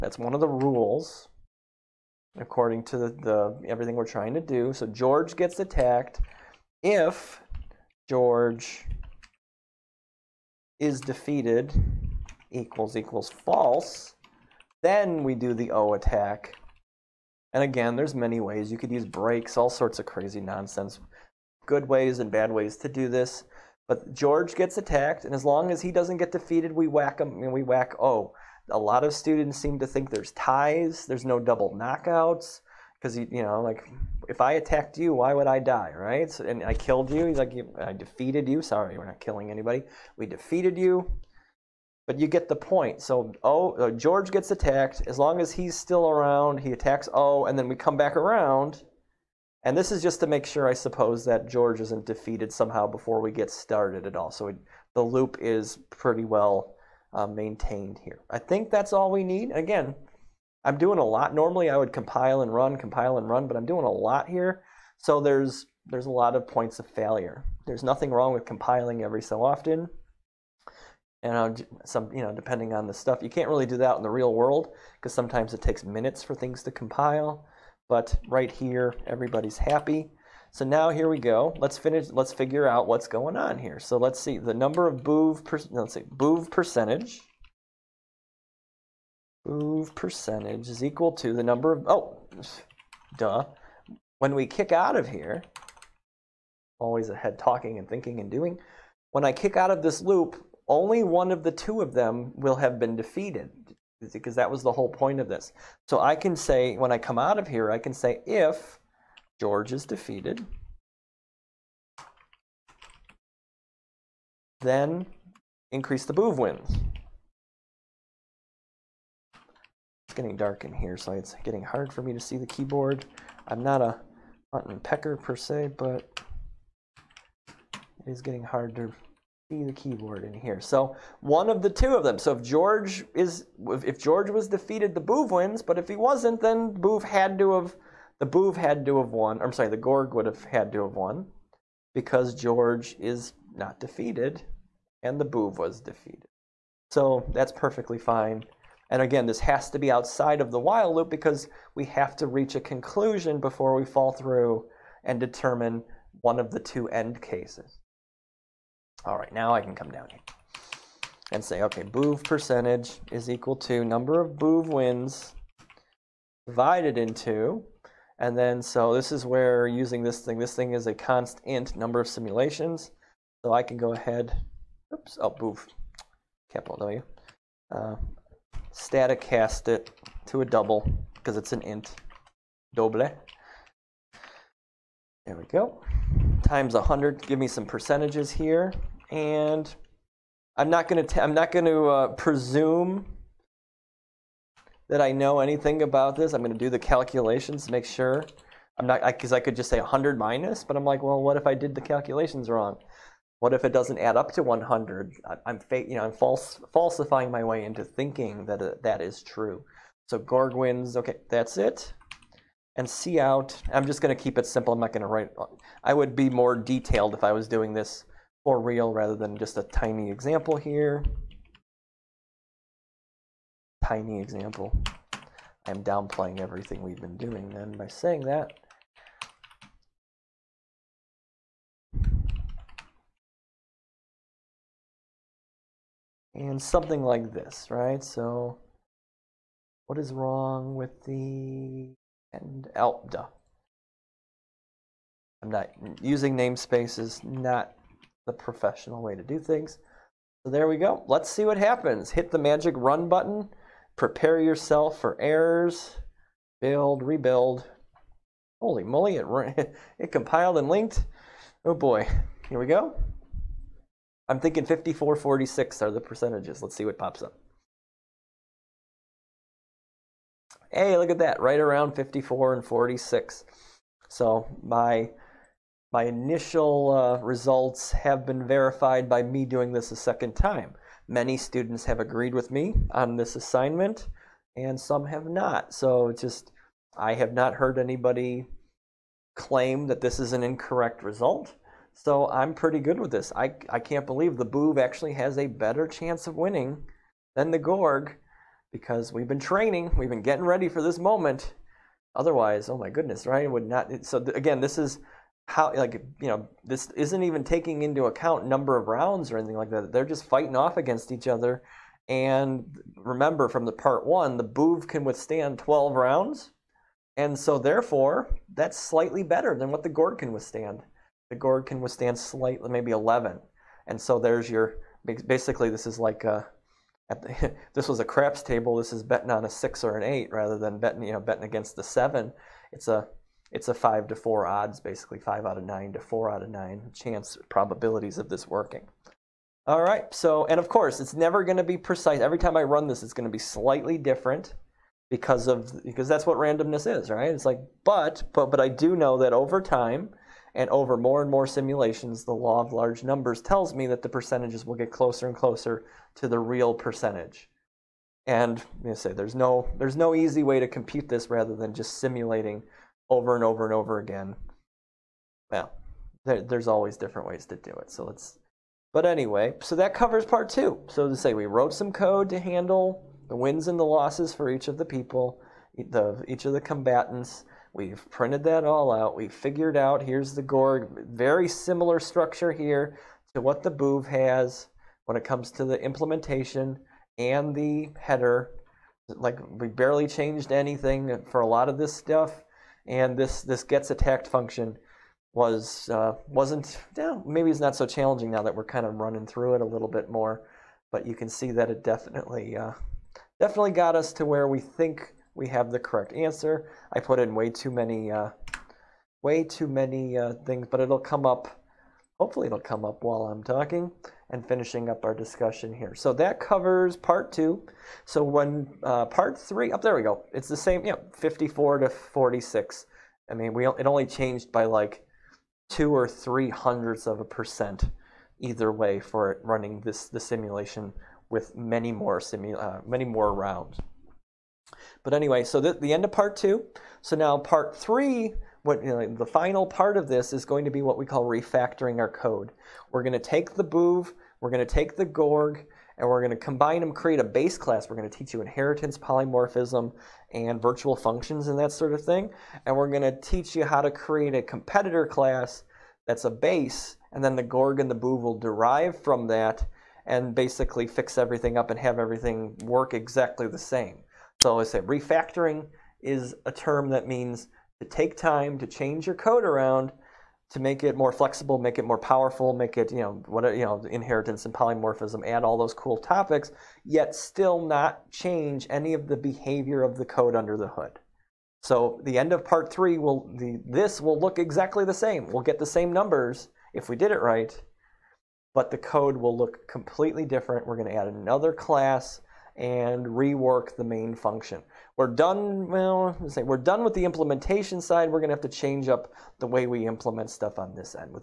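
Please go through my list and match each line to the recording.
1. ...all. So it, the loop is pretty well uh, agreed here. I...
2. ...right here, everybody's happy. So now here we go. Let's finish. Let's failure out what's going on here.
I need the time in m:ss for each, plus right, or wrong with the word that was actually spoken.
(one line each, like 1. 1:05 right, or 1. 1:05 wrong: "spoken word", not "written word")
1. 0:54 wrong: "maintained", not "agreed"
2. 1:18 wrong: "figure", not "failure".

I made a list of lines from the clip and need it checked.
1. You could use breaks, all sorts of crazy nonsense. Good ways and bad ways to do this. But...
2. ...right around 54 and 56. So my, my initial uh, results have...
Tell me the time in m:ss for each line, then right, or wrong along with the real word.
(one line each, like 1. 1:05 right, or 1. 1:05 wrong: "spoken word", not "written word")
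1. 0:18 right
2. 4:31 wrong: "46", not "56".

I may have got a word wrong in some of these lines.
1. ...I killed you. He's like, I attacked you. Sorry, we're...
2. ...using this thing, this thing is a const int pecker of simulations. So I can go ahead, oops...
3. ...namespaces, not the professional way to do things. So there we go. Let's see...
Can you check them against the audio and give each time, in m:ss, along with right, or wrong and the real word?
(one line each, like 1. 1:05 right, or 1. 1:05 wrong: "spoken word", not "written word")
1. 0:36 wrong: "defeated", not "attacked"
2. 2:49 wrong: "number", not "pecker"
3. 4:06 right.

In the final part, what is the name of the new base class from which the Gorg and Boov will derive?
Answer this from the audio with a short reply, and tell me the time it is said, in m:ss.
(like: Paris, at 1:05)
Competitor, at 7:34.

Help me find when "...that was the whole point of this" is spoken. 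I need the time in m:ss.
1:44.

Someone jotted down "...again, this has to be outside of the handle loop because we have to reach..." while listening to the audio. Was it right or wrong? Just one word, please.
wrong.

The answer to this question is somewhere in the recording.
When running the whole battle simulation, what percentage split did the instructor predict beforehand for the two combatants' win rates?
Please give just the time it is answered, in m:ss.
4:24.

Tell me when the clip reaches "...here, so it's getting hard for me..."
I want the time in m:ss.
2:00.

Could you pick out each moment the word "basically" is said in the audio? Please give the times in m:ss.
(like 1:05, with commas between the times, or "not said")
5:25, 5:34, 7:40.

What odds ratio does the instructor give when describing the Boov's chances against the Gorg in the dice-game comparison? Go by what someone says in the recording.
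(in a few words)
5 to 4.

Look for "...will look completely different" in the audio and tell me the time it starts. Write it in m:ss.
8:09.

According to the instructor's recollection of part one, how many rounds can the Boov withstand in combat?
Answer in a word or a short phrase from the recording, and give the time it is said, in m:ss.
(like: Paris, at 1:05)
12, at 5:15.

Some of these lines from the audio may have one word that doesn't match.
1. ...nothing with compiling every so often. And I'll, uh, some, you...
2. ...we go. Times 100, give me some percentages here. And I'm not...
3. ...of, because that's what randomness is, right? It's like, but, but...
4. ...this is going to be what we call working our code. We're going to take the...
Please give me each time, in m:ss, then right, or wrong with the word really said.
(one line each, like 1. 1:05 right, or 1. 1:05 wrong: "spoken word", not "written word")
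1. 1:08 wrong: "wrong", not "nothing"
2. 3:05 right
3. 5:45 right
4. 7:20 wrong: "refactoring", not "working".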